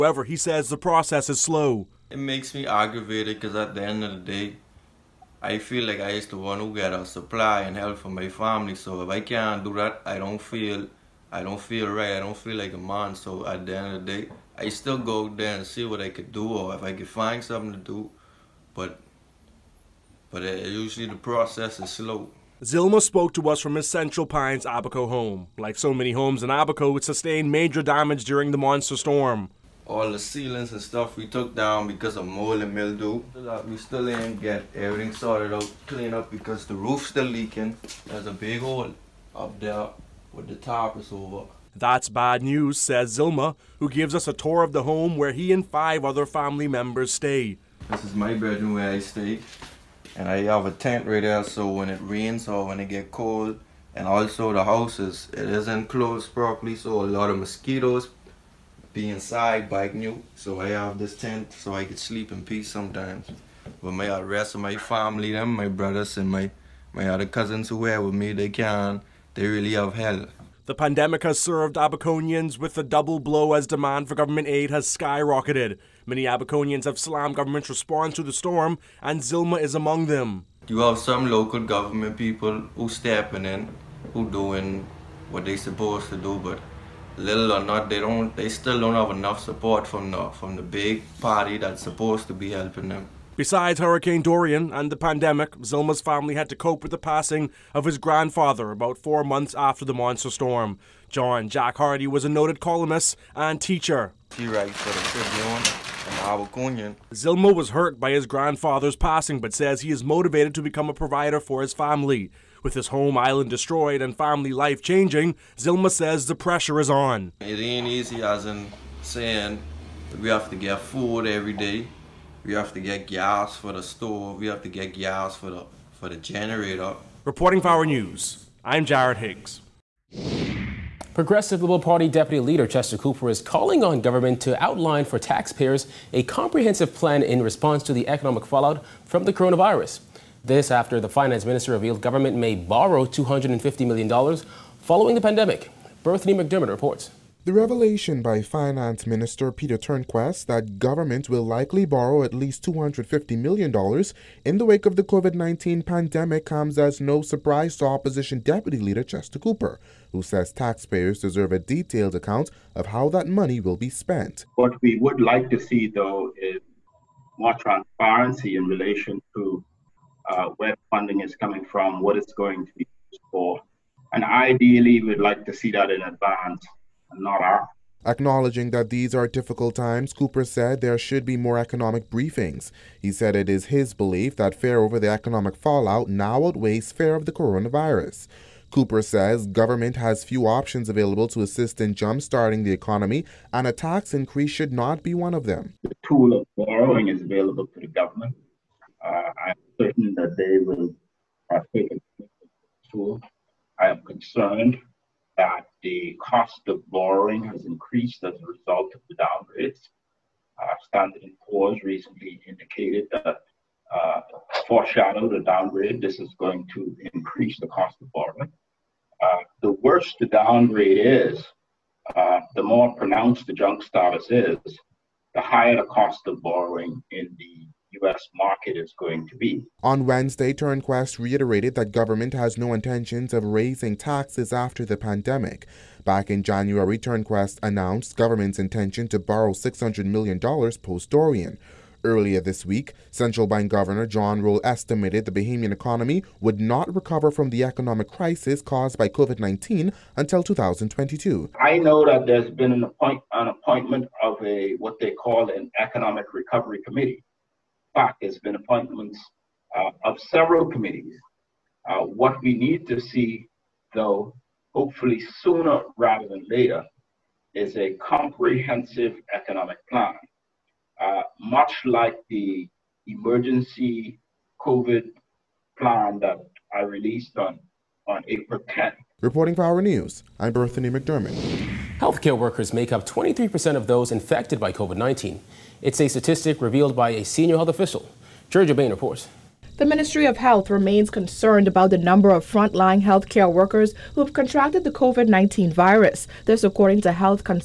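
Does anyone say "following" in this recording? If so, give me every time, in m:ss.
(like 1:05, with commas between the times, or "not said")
2:24.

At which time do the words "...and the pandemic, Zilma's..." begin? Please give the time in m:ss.
1:34.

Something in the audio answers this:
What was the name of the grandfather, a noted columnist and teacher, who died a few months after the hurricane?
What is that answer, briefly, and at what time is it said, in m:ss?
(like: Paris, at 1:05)
John Jack Hardy, at 1:41.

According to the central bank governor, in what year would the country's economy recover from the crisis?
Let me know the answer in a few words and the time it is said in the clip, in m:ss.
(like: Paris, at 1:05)
2022, at 4:10.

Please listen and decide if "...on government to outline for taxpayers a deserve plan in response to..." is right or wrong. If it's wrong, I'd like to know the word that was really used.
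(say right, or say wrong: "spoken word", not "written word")
wrong: "comprehensive", not "deserve".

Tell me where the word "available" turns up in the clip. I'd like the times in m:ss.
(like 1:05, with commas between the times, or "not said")
3:10, 3:17.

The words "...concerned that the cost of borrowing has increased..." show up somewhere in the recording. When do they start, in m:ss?
3:24.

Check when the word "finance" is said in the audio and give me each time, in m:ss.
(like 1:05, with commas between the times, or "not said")
2:21, 2:28.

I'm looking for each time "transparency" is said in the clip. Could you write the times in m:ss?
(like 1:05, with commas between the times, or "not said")
2:47.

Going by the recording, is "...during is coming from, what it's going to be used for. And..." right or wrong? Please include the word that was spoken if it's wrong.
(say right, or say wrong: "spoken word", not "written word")
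wrong: "funding", not "during".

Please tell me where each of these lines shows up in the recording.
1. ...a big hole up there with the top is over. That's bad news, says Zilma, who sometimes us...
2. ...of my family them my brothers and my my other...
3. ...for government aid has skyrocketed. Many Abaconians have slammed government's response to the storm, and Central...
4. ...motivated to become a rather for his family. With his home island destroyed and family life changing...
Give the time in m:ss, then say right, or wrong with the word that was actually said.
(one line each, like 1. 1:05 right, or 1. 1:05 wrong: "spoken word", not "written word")
1. 0:38 wrong: "gives", not "sometimes"
2. 1:04 right
3. 1:14 wrong: "Zilma", not "Central"
4. 1:50 wrong: "provider", not "rather".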